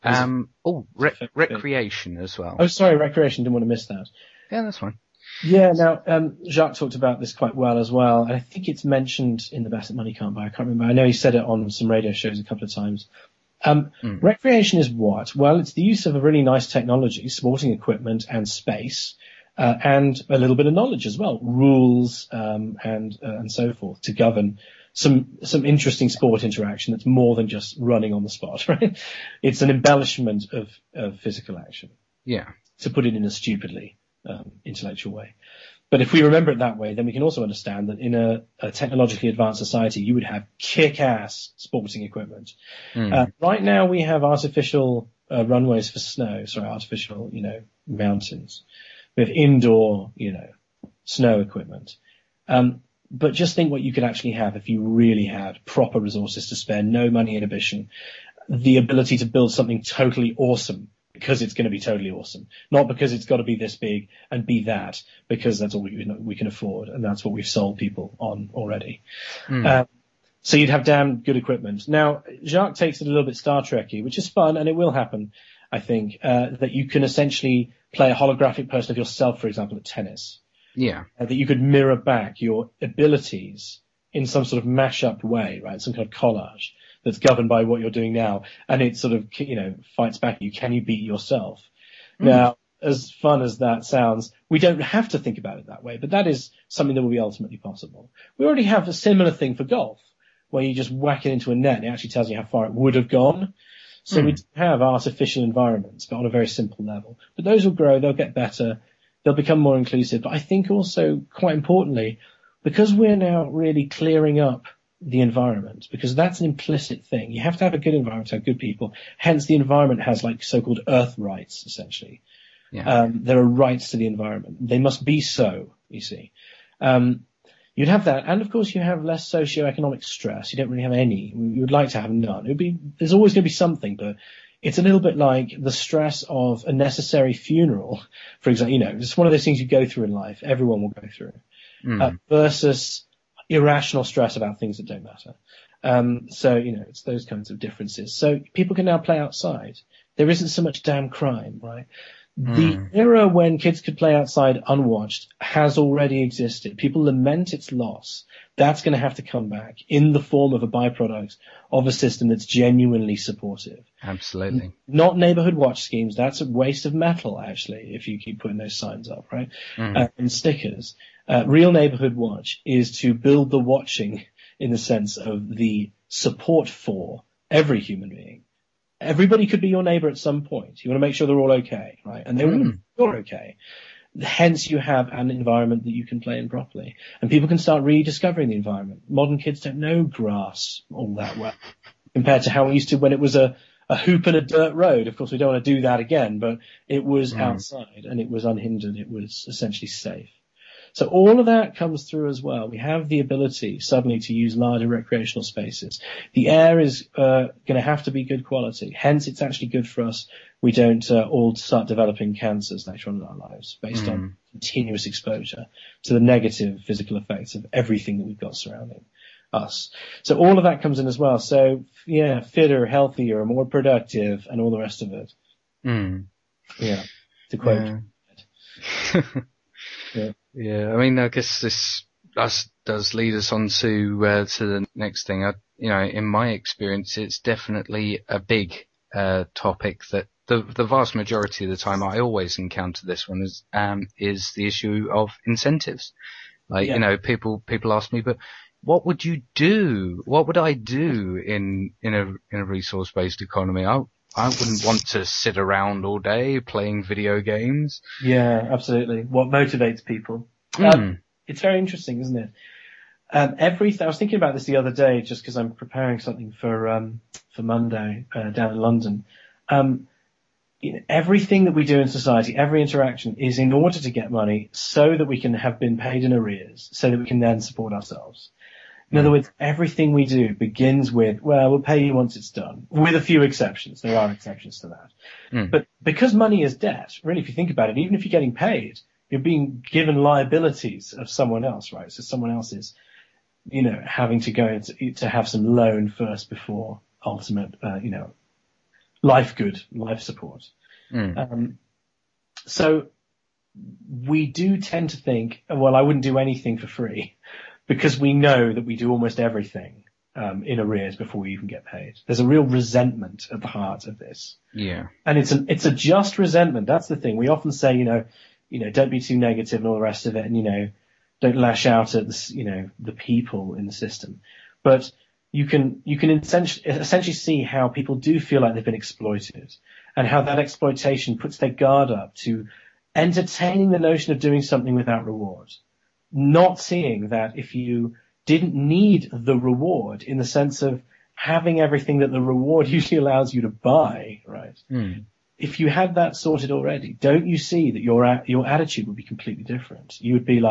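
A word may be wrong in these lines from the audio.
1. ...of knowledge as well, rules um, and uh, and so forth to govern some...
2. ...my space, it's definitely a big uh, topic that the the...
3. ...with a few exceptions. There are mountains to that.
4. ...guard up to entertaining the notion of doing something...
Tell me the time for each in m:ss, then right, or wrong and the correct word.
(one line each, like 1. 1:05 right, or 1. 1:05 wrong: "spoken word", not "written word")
1. 0:20 right
2. 3:56 wrong: "experience", not "space"
3. 4:42 wrong: "exceptions", not "mountains"
4. 5:31 right.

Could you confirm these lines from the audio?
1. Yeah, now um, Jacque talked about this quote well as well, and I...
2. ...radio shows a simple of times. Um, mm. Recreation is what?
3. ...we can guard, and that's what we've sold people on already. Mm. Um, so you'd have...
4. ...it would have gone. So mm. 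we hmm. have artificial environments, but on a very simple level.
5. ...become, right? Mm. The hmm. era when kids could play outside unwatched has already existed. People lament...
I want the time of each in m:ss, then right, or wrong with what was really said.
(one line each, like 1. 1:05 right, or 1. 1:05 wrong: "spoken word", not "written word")
1. 0:05 wrong: "quite", not "quote"
2. 0:11 wrong: "couple", not "simple"
3. 1:06 wrong: "afford", not "guard"
4. 1:42 right
5. 2:31 wrong: "crime", not "become".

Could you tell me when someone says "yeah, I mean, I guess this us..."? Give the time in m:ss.
3:50.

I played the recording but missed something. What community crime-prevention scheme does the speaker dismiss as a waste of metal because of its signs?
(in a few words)
Neighborhood watch schemes.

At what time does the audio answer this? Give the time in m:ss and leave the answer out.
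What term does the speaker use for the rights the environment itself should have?
2:00.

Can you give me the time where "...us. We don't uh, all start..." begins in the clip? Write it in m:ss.
3:30.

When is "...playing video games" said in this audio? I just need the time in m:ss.
4:16.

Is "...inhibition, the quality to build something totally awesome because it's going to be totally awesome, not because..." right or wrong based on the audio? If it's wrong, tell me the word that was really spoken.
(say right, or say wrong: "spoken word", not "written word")
wrong: "ability", not "quality".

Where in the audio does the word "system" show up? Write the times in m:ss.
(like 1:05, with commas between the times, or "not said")
2:41, 5:23.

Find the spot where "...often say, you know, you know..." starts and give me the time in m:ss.
5:17.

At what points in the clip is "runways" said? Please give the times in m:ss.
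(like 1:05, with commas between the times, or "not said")
0:45.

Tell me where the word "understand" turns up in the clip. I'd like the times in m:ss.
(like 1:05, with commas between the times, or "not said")
0:37.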